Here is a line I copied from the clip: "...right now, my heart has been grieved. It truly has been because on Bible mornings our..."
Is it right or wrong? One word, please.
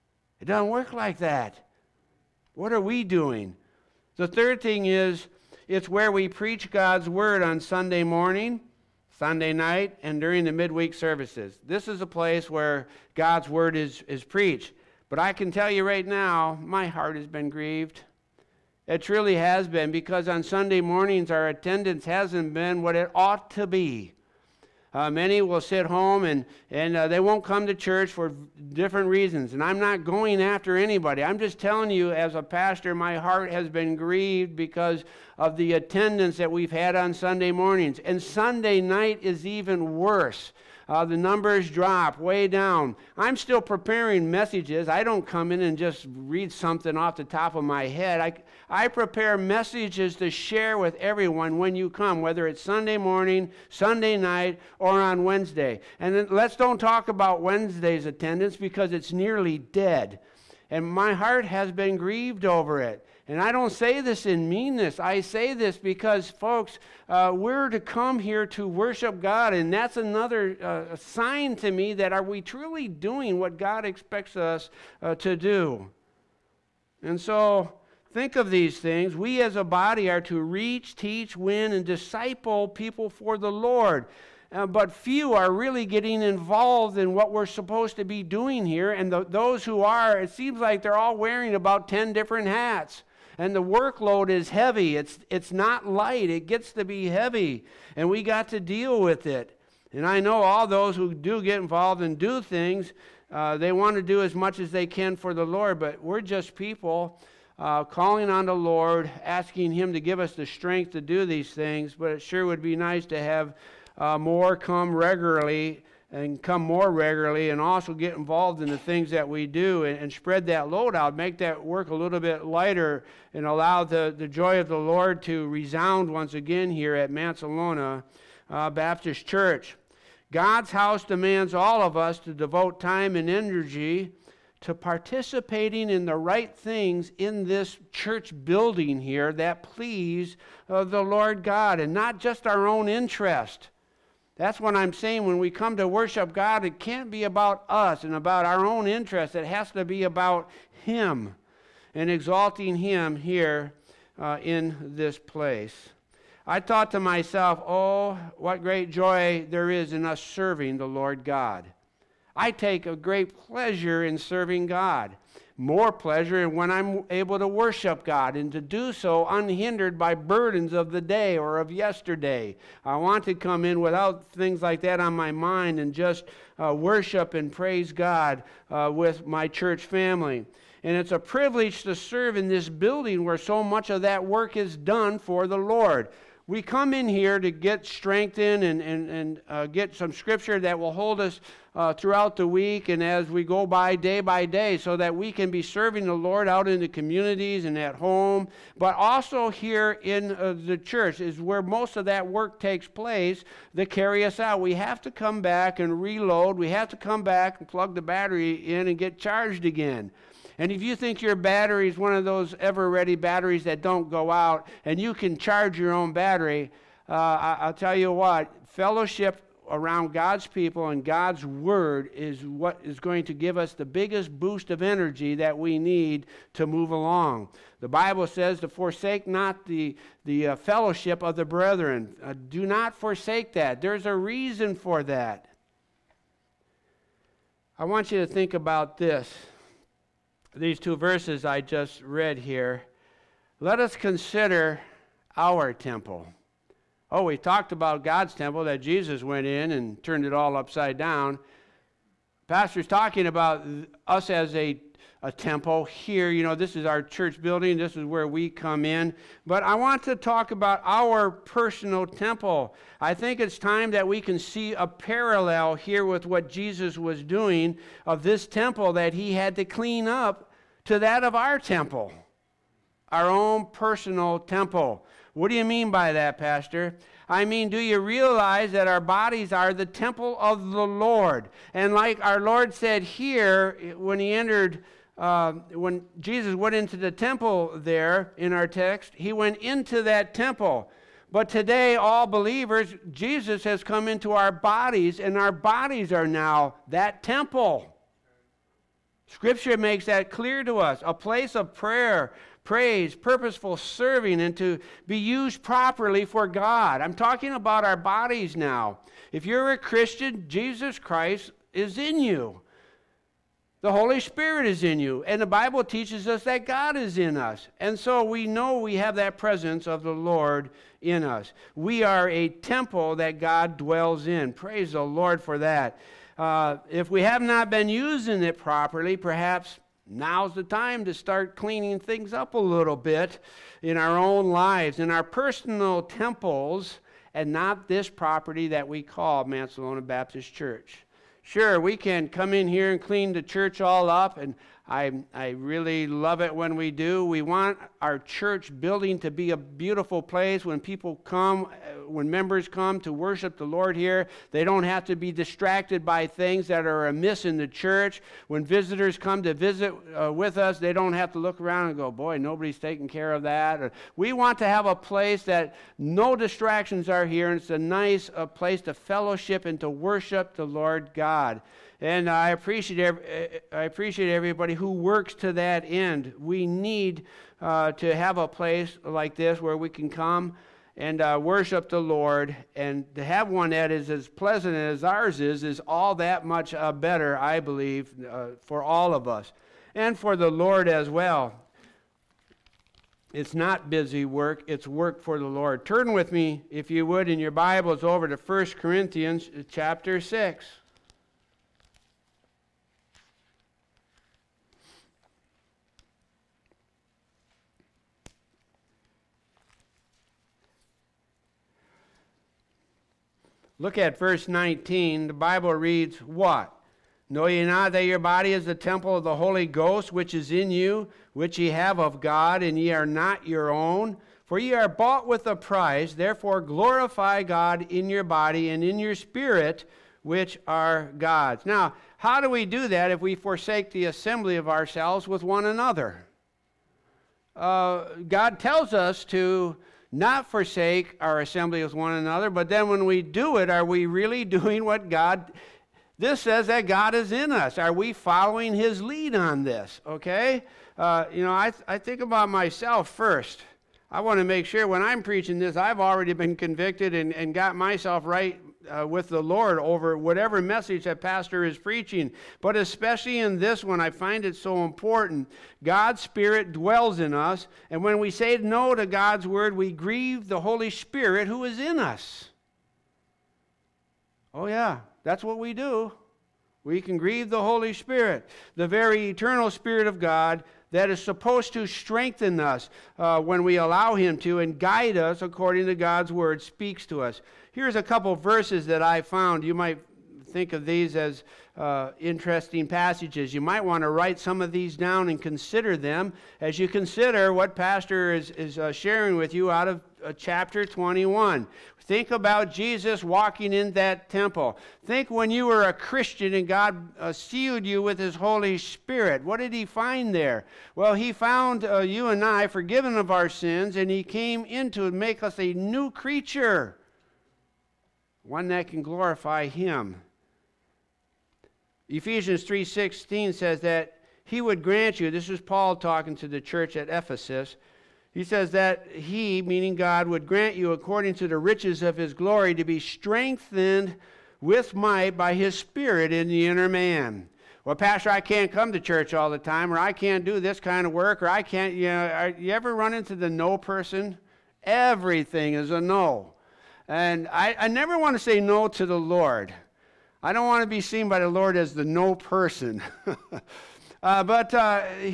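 wrong.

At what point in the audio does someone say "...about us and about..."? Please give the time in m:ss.
2:27.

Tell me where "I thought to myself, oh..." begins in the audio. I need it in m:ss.
2:36.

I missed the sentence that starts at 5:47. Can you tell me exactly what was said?
We want our church building to be a beautiful place when people come, uh, when members come to worship the Lord here.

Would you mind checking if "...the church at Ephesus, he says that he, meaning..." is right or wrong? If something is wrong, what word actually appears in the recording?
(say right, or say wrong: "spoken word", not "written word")
right.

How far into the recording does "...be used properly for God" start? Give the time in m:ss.
5:05.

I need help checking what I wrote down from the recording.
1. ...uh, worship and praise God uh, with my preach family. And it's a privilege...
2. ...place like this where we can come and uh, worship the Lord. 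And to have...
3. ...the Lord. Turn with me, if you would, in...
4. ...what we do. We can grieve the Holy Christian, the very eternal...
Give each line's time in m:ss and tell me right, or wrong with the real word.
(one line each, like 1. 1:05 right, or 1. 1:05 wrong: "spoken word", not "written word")
1. 2:56 wrong: "church", not "preach"
2. 6:18 right
3. 6:35 right
4. 7:55 wrong: "Spirit", not "Christian".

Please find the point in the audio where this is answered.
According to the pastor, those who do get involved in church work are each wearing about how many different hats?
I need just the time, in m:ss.
1:31.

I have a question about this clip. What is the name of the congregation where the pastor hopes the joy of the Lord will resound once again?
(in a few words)
Mancelona Baptist Church.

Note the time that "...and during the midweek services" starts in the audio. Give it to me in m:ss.
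0:10.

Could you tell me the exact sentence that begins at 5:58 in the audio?
When visitors come to visit uh, with us, they don't have to look around and go, boy, nobody's taking care of that.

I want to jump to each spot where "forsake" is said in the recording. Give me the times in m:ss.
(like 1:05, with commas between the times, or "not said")
3:48, 3:52, 7:13, 7:20.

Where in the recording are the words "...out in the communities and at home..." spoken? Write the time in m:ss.
3:16.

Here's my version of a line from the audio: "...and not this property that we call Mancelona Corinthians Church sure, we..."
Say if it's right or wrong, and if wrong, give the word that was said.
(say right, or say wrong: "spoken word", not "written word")
wrong: "Baptist", not "Corinthians".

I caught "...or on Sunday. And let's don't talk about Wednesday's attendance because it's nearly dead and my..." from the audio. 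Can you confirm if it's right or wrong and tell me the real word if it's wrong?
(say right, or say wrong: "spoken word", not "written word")
wrong: "Wednesday", not "Sunday".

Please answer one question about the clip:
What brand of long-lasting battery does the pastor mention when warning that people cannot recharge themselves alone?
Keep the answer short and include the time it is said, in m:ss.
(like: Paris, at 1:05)
Ever Ready, at 3:32.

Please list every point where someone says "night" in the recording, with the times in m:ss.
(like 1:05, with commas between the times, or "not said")
0:09, 0:38, 0:54.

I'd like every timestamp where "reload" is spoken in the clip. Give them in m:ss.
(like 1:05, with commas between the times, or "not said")
3:26.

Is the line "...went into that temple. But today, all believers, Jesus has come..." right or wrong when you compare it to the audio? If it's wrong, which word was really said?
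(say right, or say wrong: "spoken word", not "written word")
right.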